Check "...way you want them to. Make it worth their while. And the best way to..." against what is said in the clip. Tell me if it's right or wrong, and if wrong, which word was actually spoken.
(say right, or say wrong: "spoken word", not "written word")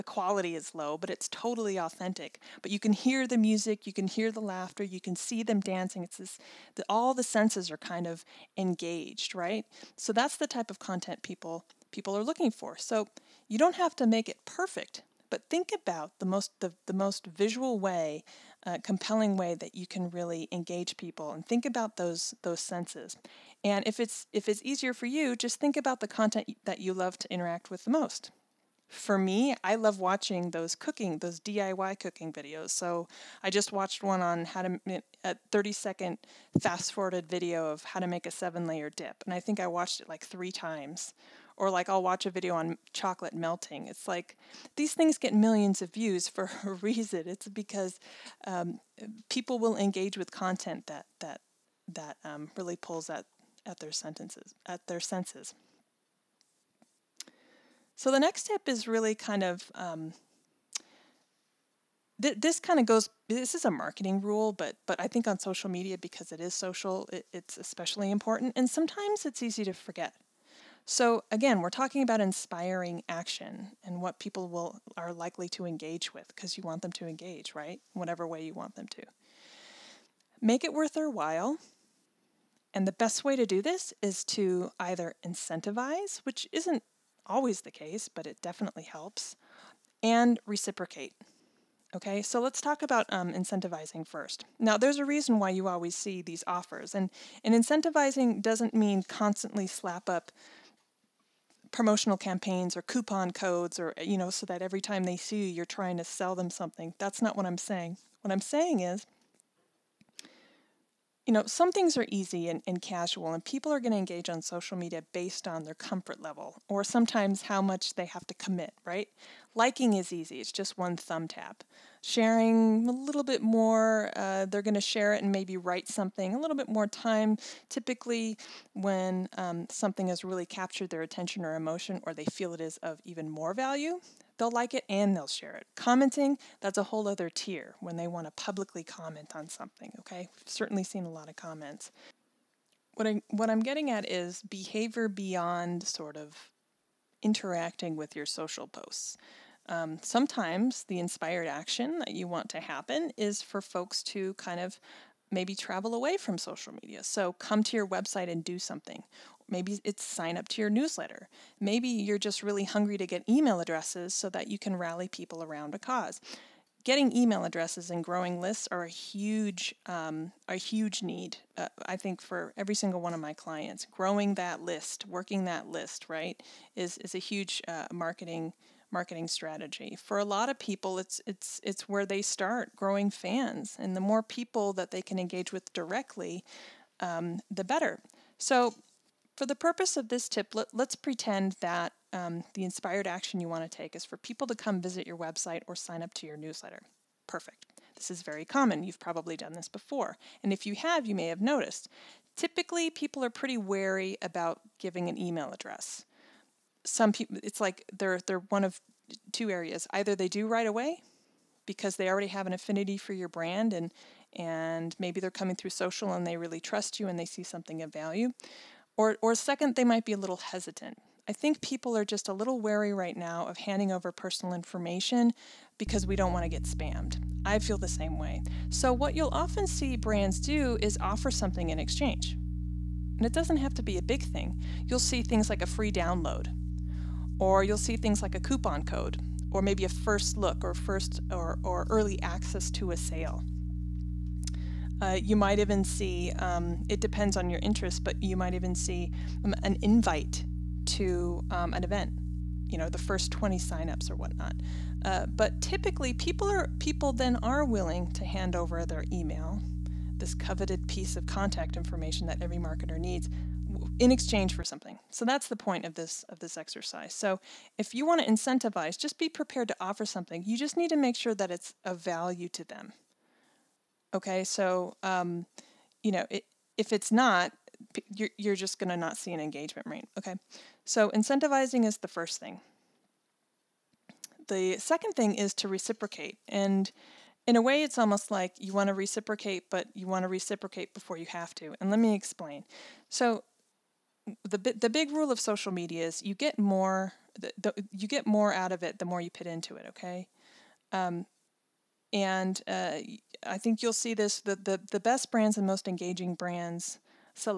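right.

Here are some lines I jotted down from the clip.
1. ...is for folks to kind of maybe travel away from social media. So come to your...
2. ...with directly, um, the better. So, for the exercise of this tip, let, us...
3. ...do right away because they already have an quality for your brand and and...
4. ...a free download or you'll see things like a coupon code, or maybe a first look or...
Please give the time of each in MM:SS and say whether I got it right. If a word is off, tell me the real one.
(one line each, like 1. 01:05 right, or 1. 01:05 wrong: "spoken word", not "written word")
1. 02:33 right
2. 03:05 wrong: "purpose", not "exercise"
3. 03:30 wrong: "affinity", not "quality"
4. 03:55 right.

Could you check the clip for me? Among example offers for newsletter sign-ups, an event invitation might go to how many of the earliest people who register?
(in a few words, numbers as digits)
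20.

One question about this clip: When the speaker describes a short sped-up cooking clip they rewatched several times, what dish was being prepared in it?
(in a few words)
seven layer dip.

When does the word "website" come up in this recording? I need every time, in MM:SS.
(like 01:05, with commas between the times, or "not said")
02:37, 03:15.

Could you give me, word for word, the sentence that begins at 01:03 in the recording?
This is a marketing rule, but but I think on social media because it is social, it, it's especially important.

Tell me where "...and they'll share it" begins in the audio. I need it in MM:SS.
02:14.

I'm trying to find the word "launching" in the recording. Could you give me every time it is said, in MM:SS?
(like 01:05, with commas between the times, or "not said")
not said.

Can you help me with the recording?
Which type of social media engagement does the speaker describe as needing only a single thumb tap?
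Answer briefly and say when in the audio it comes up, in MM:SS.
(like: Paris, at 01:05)
liking, at 01:59.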